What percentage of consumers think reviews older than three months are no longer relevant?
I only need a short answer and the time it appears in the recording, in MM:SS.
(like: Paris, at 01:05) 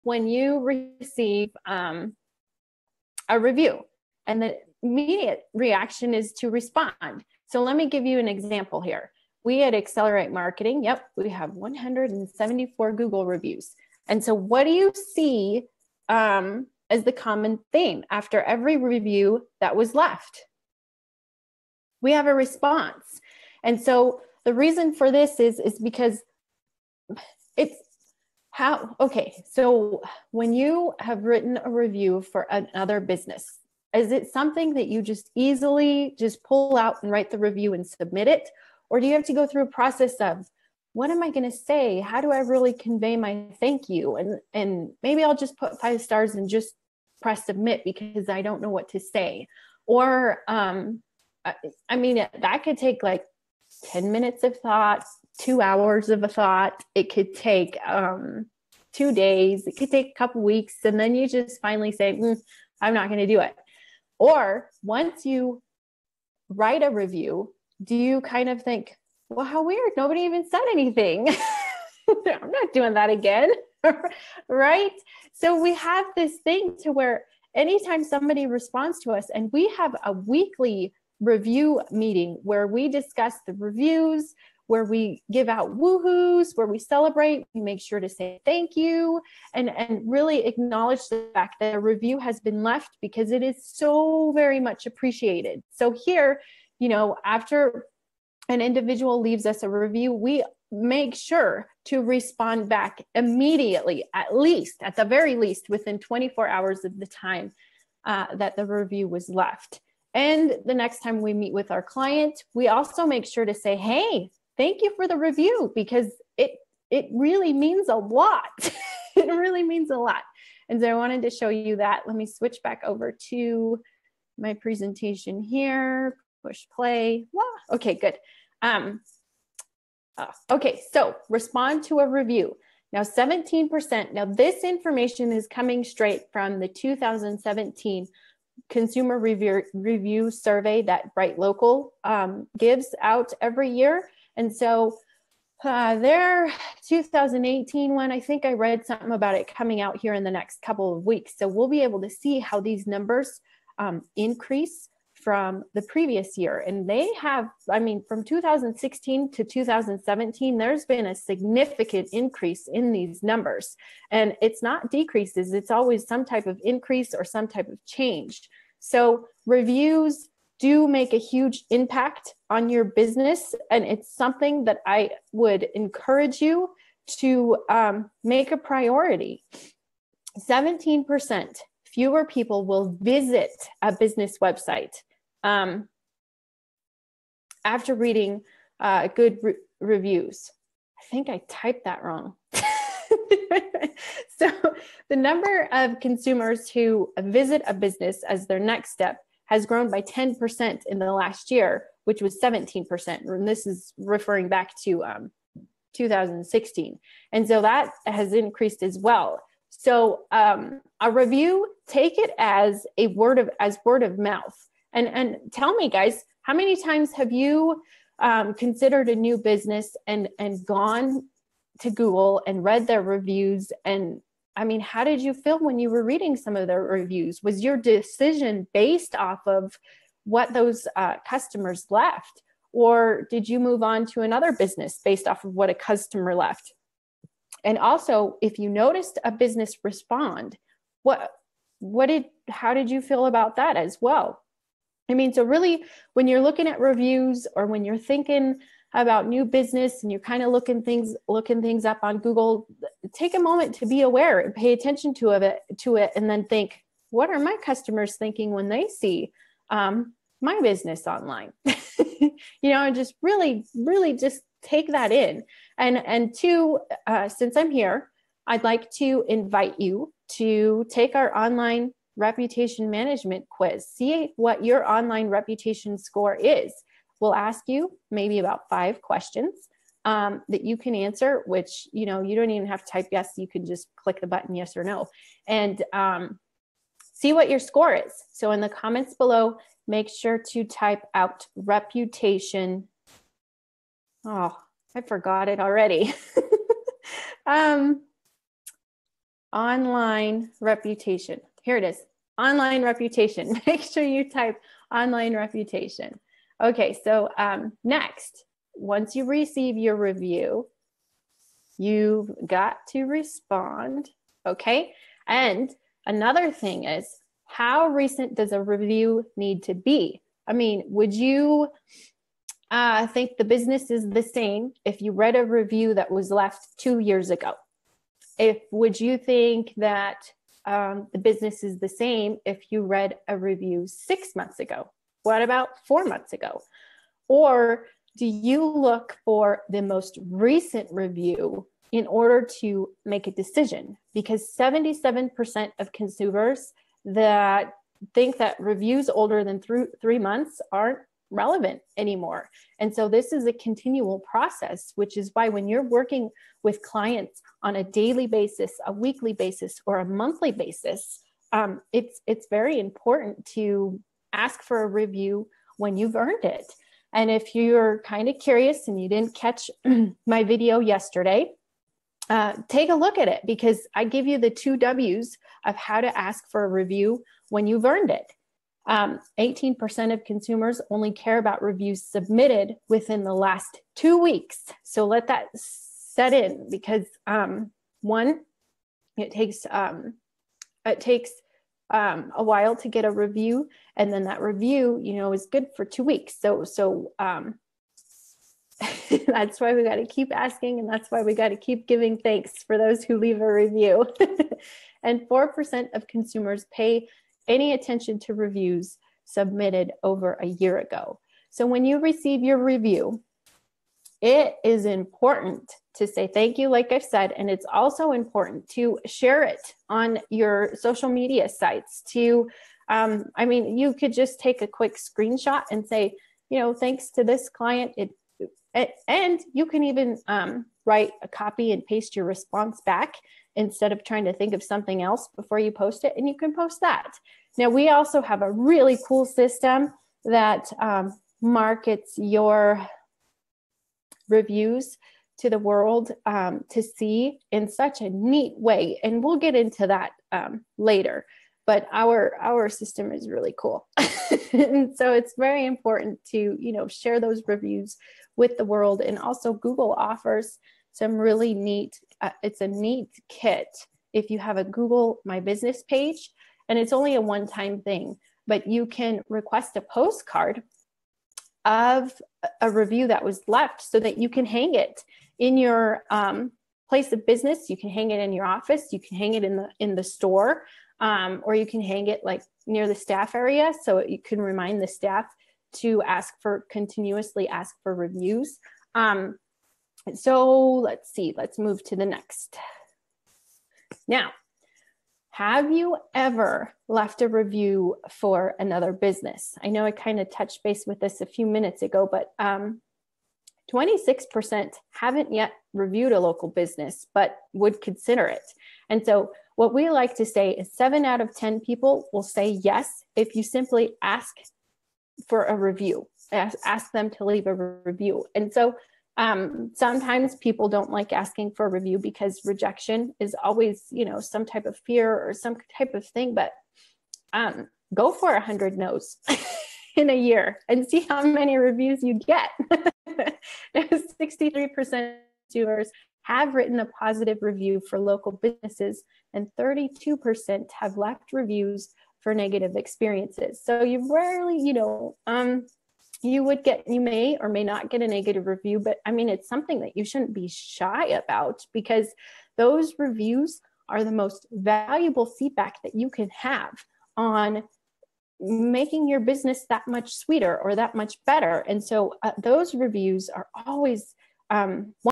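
77%, at 05:44.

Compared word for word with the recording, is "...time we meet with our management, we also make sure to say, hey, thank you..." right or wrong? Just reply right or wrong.
wrong.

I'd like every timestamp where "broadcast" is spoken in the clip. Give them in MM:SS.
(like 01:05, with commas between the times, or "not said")
not said.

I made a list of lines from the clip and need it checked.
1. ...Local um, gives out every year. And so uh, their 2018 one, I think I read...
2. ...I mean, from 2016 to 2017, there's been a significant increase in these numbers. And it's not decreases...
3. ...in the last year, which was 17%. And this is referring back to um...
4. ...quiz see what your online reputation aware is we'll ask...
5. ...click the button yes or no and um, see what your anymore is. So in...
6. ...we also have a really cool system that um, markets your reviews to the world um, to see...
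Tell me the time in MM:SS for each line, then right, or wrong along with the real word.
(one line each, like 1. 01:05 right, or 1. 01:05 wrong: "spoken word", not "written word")
1. 02:21 right
2. 02:37 right
3. 03:20 right
4. 04:33 wrong: "score", not "aware"
5. 04:43 wrong: "score", not "anymore"
6. 07:17 right.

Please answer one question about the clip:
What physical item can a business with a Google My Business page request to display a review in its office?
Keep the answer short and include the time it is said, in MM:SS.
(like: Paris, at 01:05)
a postcard, at 07:49.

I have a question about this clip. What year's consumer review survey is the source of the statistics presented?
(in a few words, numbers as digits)
2017.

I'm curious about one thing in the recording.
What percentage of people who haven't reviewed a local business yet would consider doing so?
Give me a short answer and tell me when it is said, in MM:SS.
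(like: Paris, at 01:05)
26%, at 08:23.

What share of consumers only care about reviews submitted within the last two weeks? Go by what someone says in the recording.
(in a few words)
18%.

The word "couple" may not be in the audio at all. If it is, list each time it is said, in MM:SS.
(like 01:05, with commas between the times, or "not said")
01:00, 02:30.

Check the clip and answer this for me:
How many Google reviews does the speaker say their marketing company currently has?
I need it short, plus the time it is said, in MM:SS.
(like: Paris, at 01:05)
174, at 00:11.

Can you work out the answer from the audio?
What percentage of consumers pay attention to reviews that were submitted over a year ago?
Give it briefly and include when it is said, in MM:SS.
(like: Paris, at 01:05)
4%, at 06:45.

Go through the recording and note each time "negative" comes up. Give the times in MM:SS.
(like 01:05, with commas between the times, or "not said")
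09:02, 09:08.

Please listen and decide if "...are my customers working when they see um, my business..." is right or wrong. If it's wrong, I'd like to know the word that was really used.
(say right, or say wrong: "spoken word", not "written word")
wrong: "thinking", not "working".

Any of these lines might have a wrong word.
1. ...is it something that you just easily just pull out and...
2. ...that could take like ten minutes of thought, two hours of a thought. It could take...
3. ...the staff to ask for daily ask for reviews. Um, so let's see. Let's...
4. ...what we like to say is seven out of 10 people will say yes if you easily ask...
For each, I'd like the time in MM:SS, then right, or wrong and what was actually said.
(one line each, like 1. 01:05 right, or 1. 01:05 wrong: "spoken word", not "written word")
1. 00:33 right
2. 00:52 right
3. 08:04 wrong: "continuously", not "daily"
4. 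08:29 wrong: "simply", not "easily".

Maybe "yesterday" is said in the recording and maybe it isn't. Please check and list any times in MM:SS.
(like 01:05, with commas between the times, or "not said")
06:10.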